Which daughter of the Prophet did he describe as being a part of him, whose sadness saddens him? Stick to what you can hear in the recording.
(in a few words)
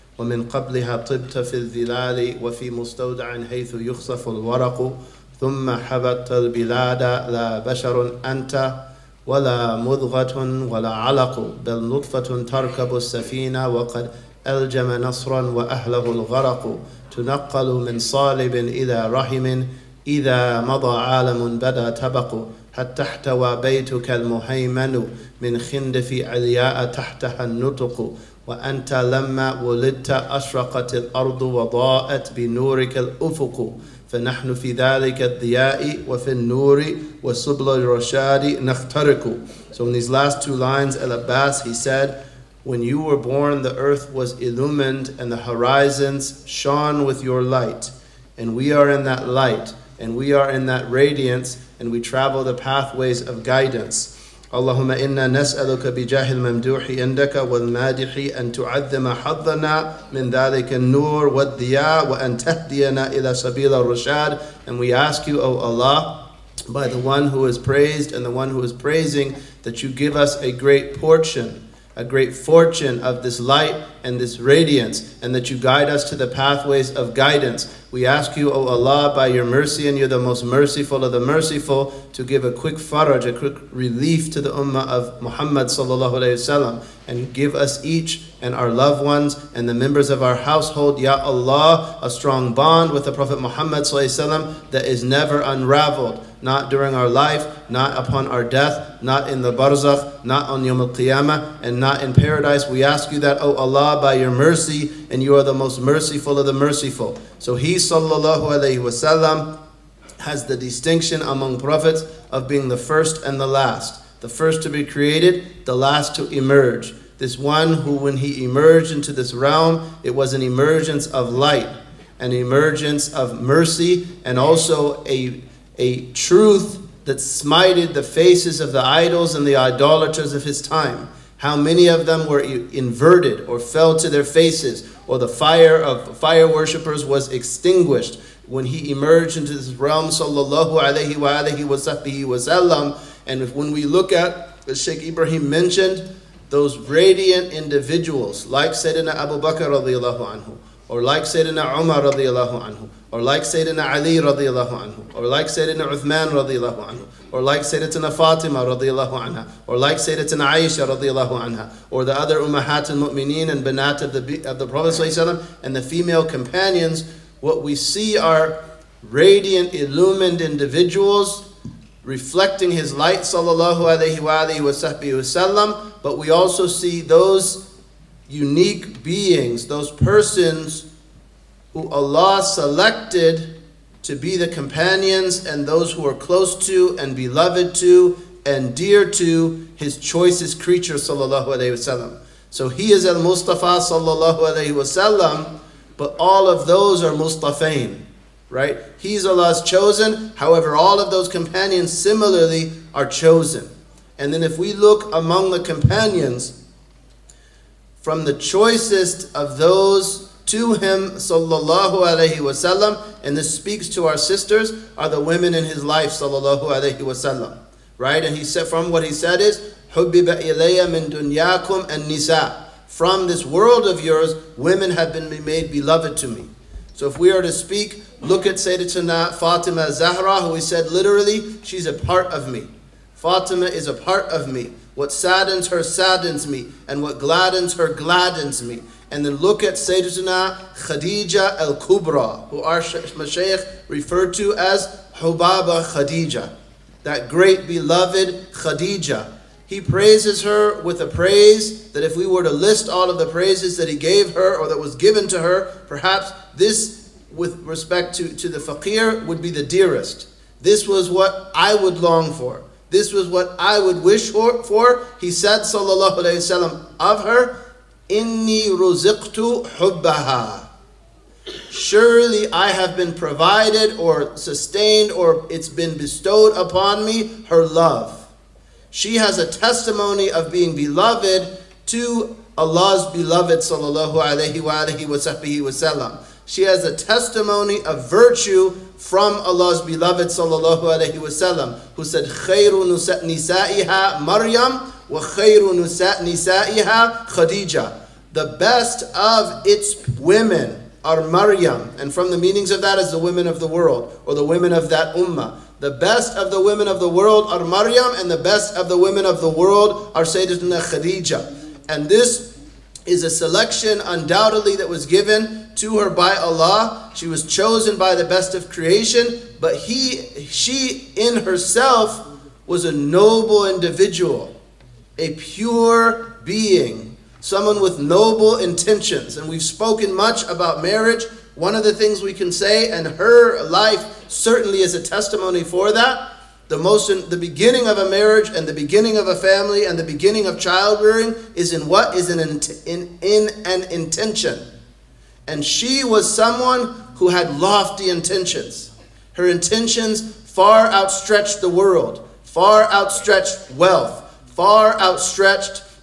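Fatima Zahra.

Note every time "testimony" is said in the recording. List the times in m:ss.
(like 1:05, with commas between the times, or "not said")
4:39, 4:46, 5:35.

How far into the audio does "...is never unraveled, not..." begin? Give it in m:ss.
1:34.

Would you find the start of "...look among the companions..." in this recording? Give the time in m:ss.
3:24.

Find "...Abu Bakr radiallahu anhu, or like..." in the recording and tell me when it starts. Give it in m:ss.
2:29.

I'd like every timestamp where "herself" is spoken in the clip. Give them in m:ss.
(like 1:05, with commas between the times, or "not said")
5:21.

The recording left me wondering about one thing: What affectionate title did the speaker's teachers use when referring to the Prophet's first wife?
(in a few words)
Hubaba Khadija.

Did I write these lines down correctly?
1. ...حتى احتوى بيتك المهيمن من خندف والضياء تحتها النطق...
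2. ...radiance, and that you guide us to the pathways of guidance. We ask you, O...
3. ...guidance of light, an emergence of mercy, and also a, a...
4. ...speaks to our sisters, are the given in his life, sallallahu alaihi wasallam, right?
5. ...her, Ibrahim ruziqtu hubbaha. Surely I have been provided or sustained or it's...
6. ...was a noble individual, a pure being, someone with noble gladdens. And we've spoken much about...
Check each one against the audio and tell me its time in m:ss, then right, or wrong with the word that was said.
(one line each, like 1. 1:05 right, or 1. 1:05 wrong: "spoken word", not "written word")
1. 0:22 wrong: "علياء", not "والضياء"
2. 1:14 right
3. 2:00 wrong: "emergence", not "guidance"
4. 3:33 wrong: "women", not "given"
5. 4:27 wrong: "Inni", not "Ibrahim"
6. 5:22 wrong: "intentions", not "gladdens".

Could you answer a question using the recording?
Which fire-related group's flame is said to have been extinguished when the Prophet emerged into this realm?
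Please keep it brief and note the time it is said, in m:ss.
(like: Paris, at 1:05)
Fire worshippers, at 2:16.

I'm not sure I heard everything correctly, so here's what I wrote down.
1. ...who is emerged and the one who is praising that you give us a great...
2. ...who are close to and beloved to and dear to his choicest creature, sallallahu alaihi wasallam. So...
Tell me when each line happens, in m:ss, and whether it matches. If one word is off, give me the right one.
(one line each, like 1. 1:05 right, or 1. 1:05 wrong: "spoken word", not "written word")
1. 1:07 wrong: "praised", not "emerged"
2. 3:05 right.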